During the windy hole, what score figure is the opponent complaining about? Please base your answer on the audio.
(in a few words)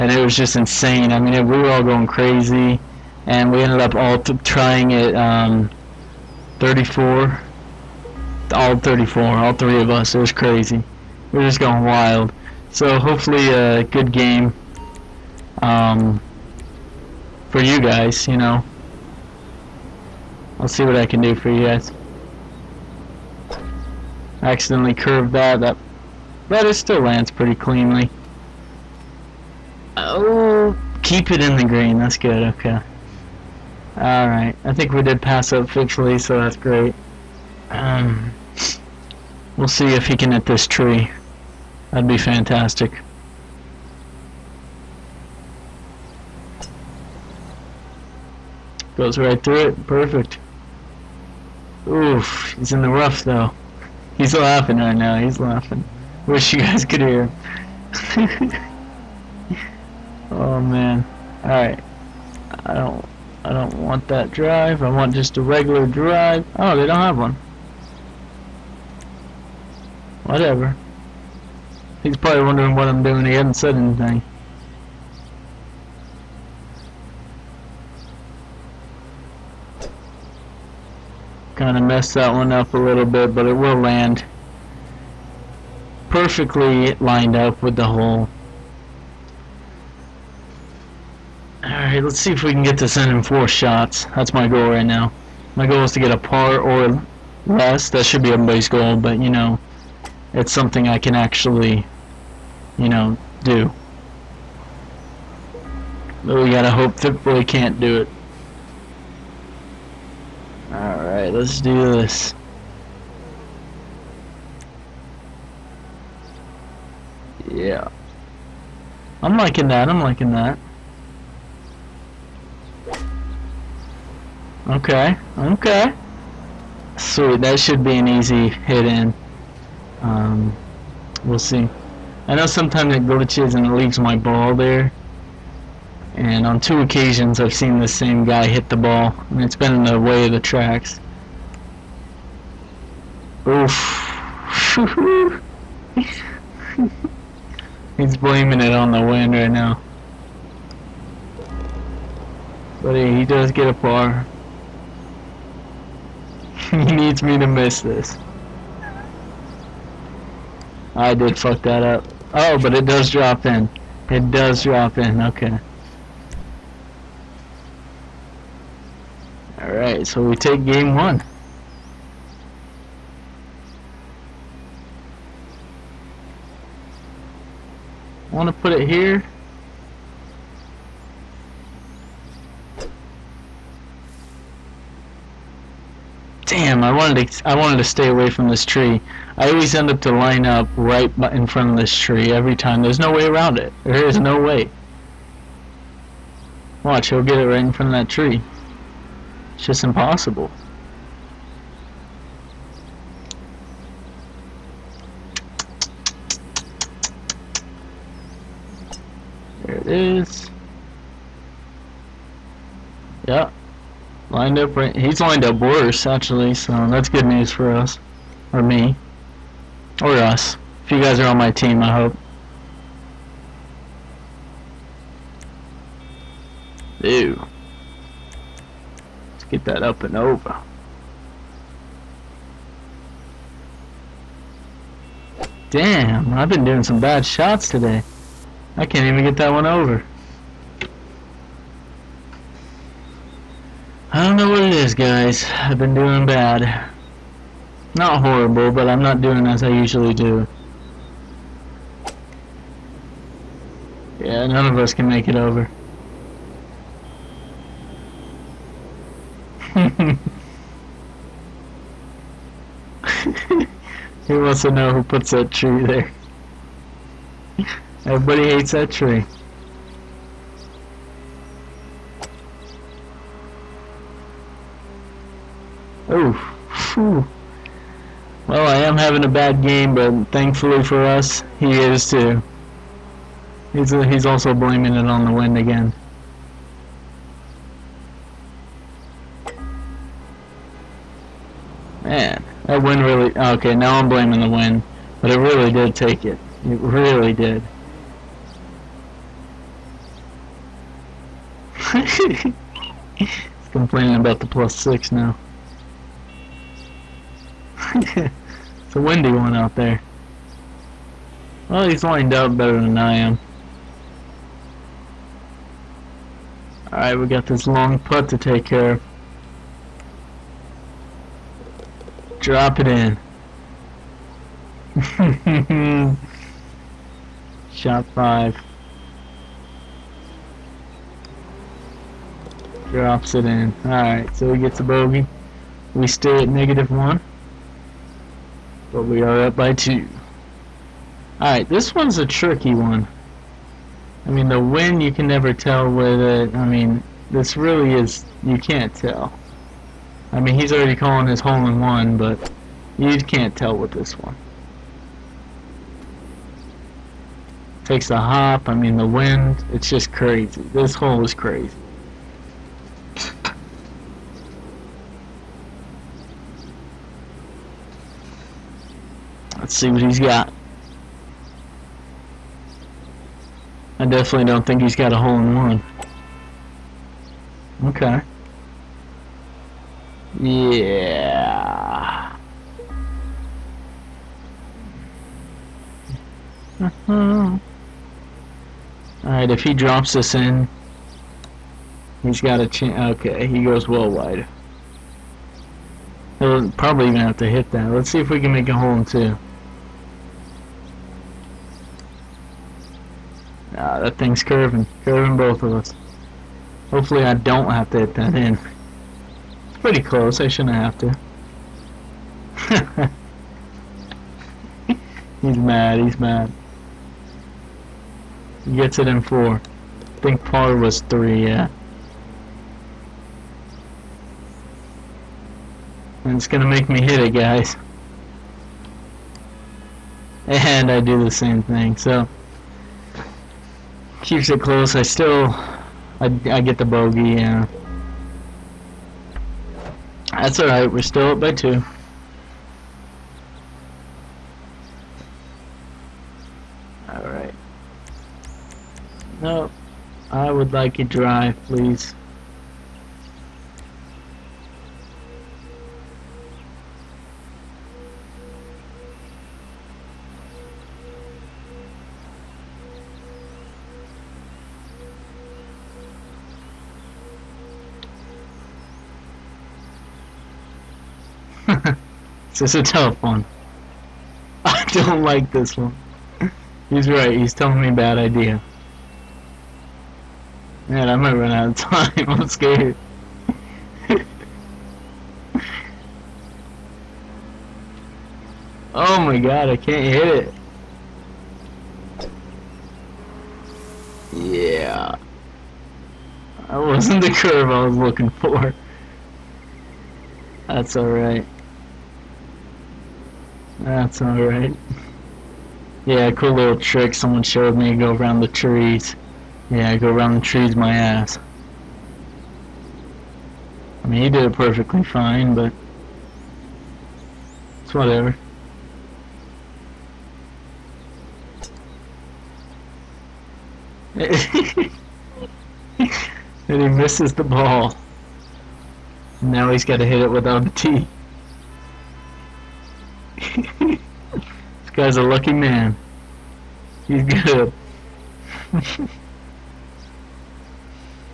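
plus 6.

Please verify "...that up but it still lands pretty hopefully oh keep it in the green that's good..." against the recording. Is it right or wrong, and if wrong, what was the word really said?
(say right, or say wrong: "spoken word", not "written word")
wrong: "cleanly", not "hopefully".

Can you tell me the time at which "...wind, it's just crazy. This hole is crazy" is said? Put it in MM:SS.
05:59.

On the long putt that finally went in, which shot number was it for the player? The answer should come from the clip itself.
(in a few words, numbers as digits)
5.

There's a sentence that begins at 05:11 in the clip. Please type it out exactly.
Well, he's lined up better than I am.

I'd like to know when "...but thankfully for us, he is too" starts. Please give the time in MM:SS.
04:39.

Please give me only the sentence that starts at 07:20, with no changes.
That's alright, we're still up by two.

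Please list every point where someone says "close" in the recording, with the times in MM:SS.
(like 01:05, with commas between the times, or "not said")
06:50, 07:14.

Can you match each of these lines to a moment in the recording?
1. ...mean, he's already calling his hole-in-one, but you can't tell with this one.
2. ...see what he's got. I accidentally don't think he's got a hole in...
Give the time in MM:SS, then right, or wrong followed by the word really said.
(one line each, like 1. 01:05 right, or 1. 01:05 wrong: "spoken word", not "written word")
1. 05:50 right
2. 06:09 wrong: "definitely", not "accidentally".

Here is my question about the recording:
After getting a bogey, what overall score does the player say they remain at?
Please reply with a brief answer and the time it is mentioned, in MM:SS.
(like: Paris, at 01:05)
negative 1, at 05:36.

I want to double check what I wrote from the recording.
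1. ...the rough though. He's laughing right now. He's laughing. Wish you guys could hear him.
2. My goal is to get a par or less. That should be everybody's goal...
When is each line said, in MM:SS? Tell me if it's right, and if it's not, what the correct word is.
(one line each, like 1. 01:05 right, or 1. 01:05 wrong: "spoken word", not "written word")
1. 00:52 right
2. 01:35 right.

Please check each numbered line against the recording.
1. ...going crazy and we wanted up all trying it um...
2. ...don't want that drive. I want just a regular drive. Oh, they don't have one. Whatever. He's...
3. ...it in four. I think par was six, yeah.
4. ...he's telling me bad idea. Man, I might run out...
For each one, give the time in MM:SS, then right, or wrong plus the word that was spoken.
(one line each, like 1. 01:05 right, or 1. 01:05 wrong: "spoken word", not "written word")
1. 00:01 wrong: "ended", not "wanted"
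2. 01:03 right
3. 06:58 wrong: "three", not "six"
4. 07:57 right.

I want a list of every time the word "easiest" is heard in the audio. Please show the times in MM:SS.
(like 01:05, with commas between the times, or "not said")
not said.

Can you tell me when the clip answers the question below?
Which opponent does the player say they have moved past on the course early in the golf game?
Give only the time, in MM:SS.
00:35.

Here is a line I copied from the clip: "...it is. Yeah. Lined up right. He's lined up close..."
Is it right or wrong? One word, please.
wrong.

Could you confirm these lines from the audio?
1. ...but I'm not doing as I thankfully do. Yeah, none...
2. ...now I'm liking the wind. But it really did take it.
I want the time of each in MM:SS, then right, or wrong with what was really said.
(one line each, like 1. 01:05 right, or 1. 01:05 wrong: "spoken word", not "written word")
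1. 04:08 wrong: "usually", not "thankfully"
2. 04:53 wrong: "blaming", not "liking".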